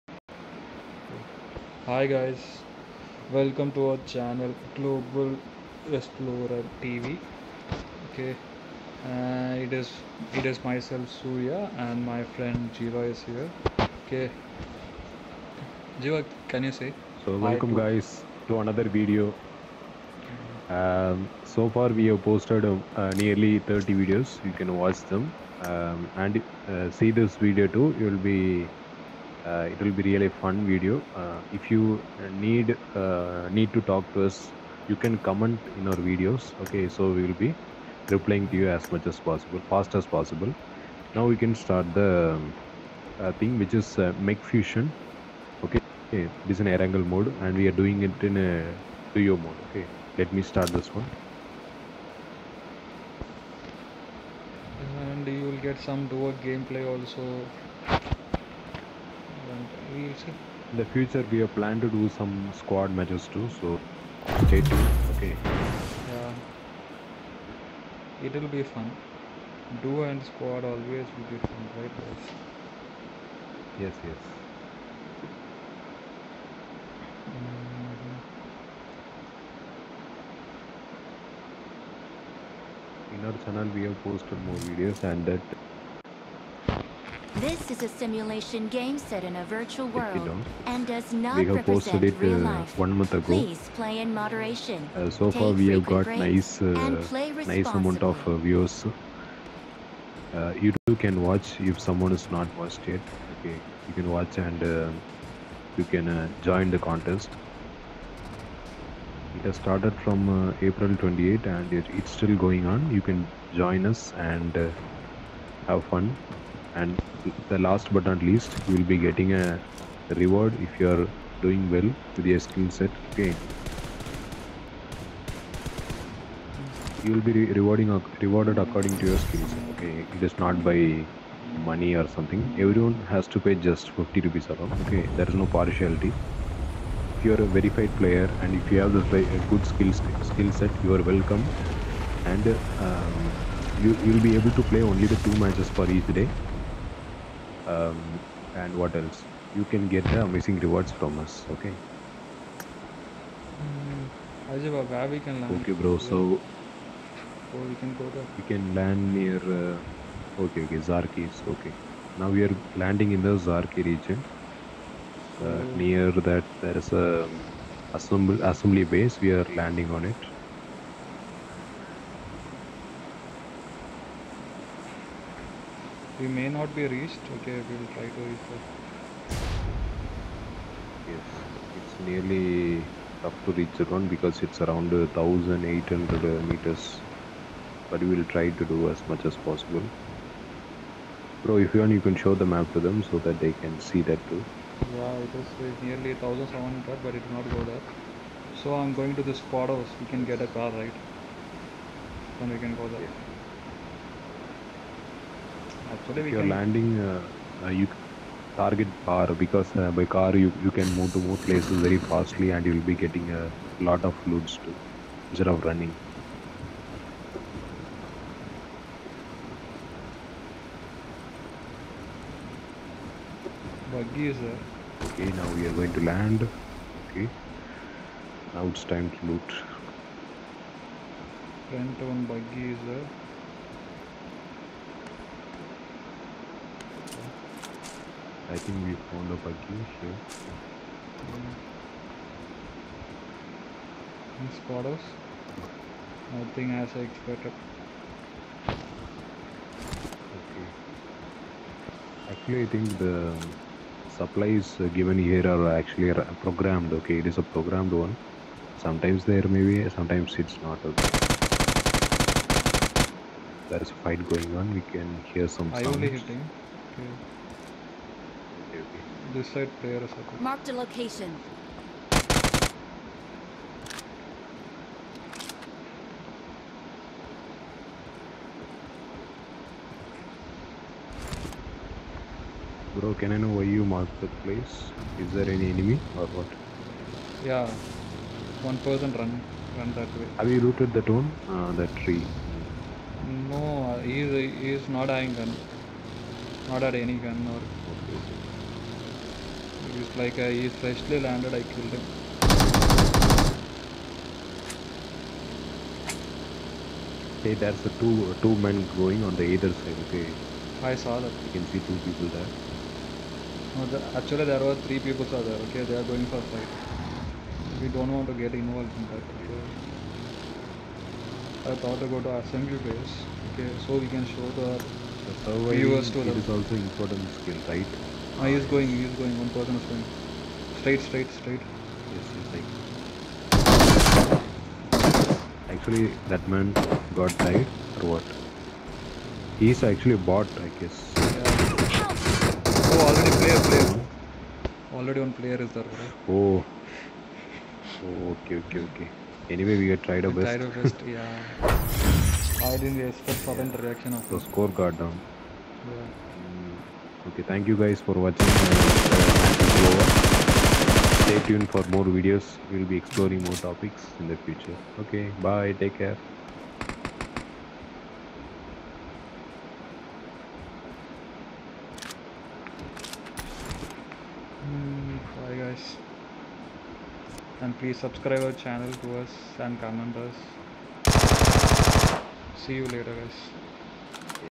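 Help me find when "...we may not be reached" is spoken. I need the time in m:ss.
2:56.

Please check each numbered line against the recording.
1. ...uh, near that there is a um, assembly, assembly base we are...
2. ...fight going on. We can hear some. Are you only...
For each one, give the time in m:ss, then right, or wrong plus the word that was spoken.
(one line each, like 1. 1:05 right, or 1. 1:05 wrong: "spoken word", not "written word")
1. 2:45 right
2. 4:24 right.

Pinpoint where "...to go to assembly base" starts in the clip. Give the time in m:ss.
5:21.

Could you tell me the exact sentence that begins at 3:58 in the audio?
I think we found a bugging here.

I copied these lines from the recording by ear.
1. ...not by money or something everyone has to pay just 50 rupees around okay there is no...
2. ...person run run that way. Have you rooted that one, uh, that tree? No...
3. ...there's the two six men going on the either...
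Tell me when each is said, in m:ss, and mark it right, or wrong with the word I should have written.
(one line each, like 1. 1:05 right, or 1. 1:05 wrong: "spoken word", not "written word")
1. 2:10 right
2. 4:48 right
3. 5:07 wrong: "two", not "six".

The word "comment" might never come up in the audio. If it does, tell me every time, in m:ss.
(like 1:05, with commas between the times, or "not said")
0:35, 6:19.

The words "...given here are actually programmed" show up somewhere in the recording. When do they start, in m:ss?
4:14.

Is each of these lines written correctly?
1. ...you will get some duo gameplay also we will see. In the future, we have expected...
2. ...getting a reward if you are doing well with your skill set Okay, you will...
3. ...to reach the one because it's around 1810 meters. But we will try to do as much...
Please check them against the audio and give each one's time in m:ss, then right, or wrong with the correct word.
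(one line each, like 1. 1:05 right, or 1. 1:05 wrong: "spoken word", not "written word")
1. 0:55 wrong: "planned", not "expected"
2. 1:58 right
3. 3:03 wrong: "1800", not "1810".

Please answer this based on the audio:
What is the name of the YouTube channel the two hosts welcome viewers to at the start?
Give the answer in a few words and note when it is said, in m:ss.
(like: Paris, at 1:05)
Global Explorer TV, at 0:04.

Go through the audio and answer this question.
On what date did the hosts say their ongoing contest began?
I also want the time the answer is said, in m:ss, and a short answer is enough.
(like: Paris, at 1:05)
April 28, at 1:50.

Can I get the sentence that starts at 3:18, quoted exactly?
So I'm going to this spot house.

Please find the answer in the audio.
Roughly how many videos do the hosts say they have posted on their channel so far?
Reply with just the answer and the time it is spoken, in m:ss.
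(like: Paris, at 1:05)
30, at 0:23.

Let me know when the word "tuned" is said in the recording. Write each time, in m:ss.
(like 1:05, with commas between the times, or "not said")
1:04, 6:01.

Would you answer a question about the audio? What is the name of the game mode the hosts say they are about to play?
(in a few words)
Mecha Fusion.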